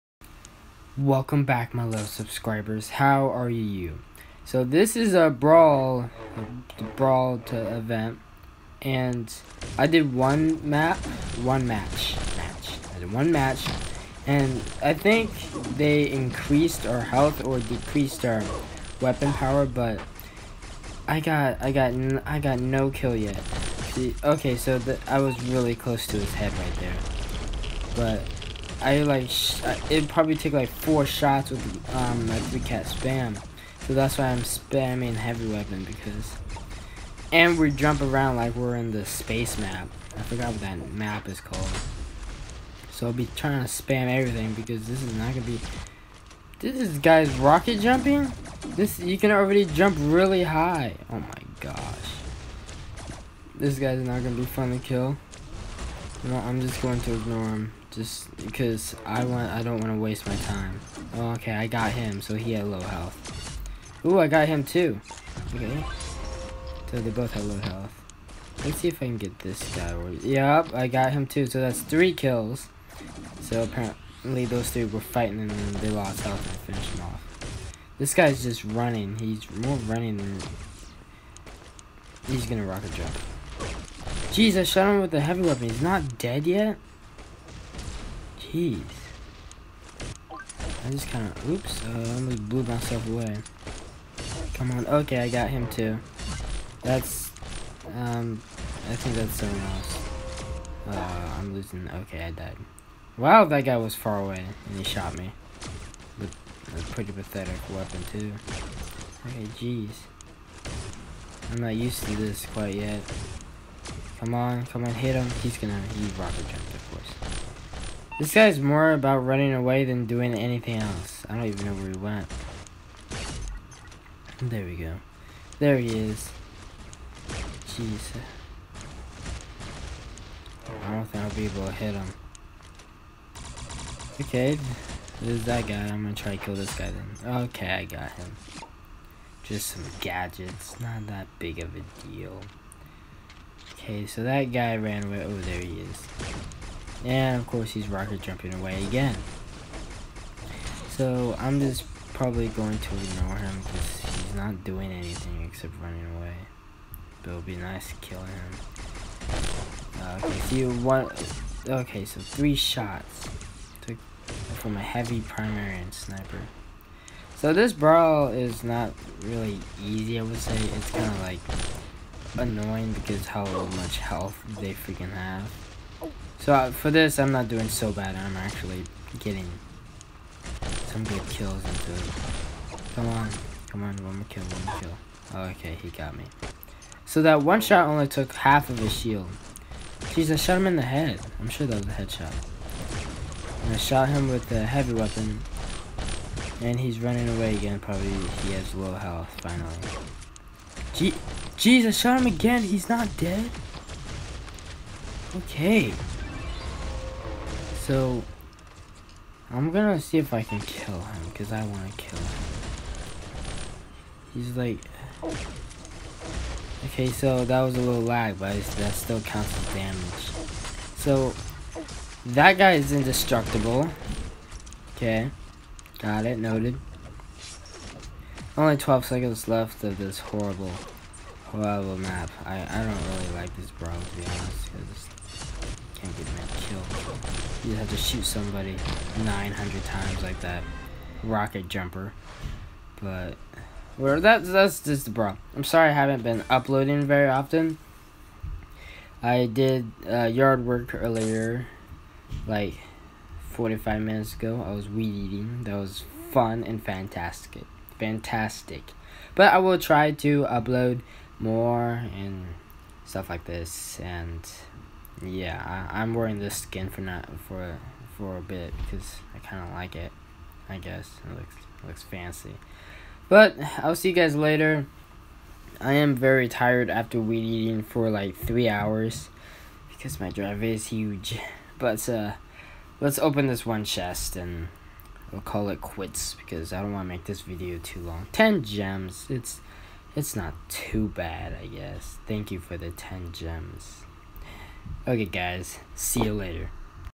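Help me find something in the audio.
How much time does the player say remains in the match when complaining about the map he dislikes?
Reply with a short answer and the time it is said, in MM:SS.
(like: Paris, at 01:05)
12 seconds, at 03:48.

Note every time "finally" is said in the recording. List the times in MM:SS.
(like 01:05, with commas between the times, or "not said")
03:19.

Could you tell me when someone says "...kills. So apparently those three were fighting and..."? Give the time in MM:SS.
01:12.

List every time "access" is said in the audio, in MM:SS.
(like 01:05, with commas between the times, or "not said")
not said.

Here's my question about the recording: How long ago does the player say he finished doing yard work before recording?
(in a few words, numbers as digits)
45 minutes.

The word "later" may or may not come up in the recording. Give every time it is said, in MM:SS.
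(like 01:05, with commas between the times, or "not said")
04:34, 04:56.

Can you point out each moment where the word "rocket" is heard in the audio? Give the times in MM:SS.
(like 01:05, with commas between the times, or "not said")
00:47, 01:22, 01:56, 02:27, 04:01.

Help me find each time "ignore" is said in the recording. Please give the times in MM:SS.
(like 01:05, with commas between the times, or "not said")
00:57, 02:32.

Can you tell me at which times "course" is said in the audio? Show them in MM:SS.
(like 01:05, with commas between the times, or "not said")
01:56, 02:27.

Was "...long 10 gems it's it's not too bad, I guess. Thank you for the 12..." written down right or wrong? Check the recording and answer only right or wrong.
wrong.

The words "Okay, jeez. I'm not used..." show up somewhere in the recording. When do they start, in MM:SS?
01:49.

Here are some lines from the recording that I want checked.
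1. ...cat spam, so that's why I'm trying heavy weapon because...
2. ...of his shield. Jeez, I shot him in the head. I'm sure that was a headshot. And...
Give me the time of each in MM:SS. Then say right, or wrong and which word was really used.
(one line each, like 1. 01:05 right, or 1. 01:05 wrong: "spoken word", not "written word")
1. 00:32 wrong: "spamming", not "trying"
2. 03:08 right.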